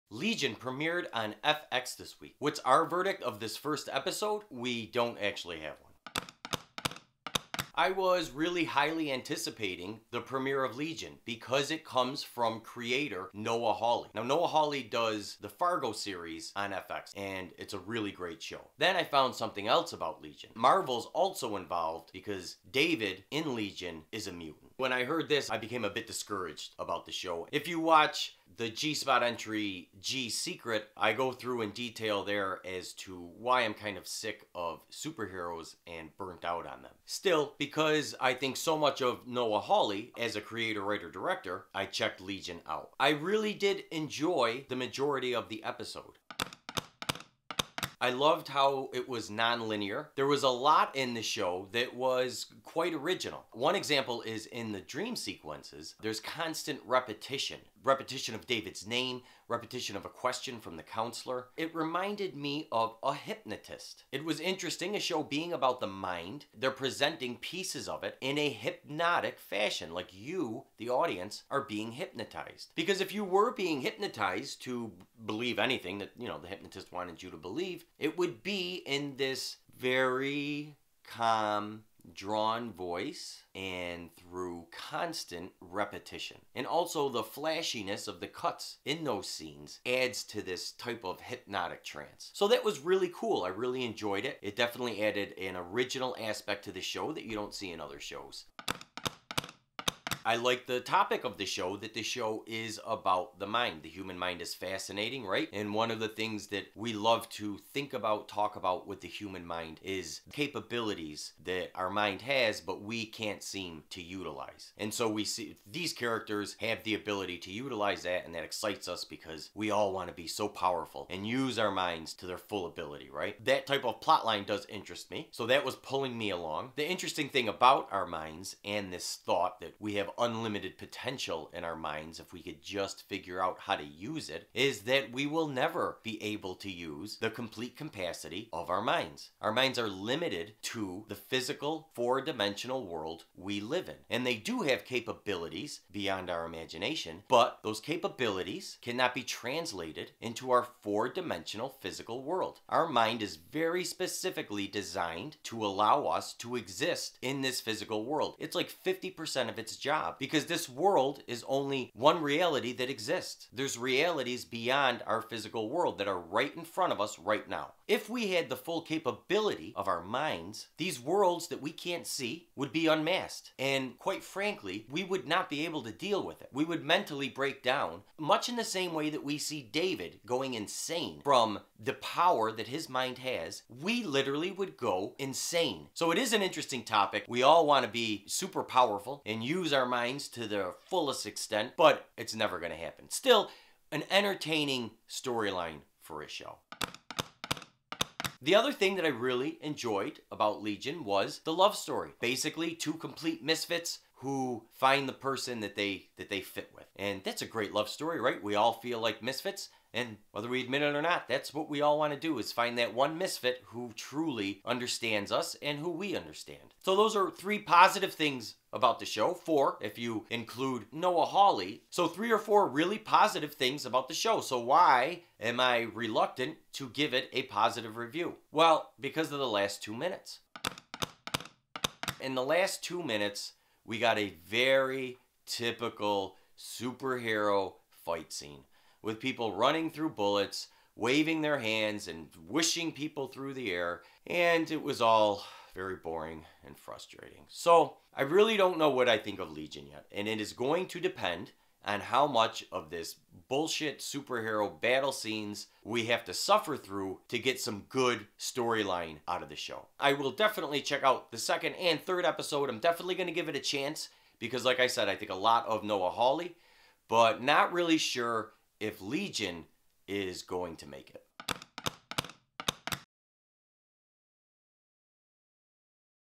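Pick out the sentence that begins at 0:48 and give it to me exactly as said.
I loved how it was non-linear.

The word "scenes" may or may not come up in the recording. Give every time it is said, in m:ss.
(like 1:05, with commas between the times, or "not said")
1:29, 3:58, 4:15.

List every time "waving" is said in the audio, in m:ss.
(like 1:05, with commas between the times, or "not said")
4:00.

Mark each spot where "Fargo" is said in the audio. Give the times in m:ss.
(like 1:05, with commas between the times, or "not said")
0:15.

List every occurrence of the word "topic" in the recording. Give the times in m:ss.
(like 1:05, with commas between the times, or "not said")
1:40, 3:06.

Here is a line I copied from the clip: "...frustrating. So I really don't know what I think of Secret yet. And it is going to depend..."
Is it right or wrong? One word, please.
wrong.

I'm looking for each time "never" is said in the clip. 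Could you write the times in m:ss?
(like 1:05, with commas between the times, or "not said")
2:15, 3:12.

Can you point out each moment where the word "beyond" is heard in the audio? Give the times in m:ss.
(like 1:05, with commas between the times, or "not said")
2:25, 2:44.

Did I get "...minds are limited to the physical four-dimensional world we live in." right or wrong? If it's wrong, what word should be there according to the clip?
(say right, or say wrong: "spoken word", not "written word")
right.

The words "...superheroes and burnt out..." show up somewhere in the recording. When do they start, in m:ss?
0:34.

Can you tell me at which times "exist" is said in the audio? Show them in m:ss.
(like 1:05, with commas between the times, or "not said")
2:36, 2:42.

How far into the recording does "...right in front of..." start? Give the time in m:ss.
2:46.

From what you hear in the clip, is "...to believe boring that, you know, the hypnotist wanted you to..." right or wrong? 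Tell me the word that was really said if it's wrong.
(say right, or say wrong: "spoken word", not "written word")
wrong: "anything", not "boring".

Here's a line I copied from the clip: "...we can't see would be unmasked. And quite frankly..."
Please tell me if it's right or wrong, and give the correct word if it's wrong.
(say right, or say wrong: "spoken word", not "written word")
right.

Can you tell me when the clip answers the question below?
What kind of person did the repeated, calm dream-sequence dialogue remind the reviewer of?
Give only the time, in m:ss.
1:03.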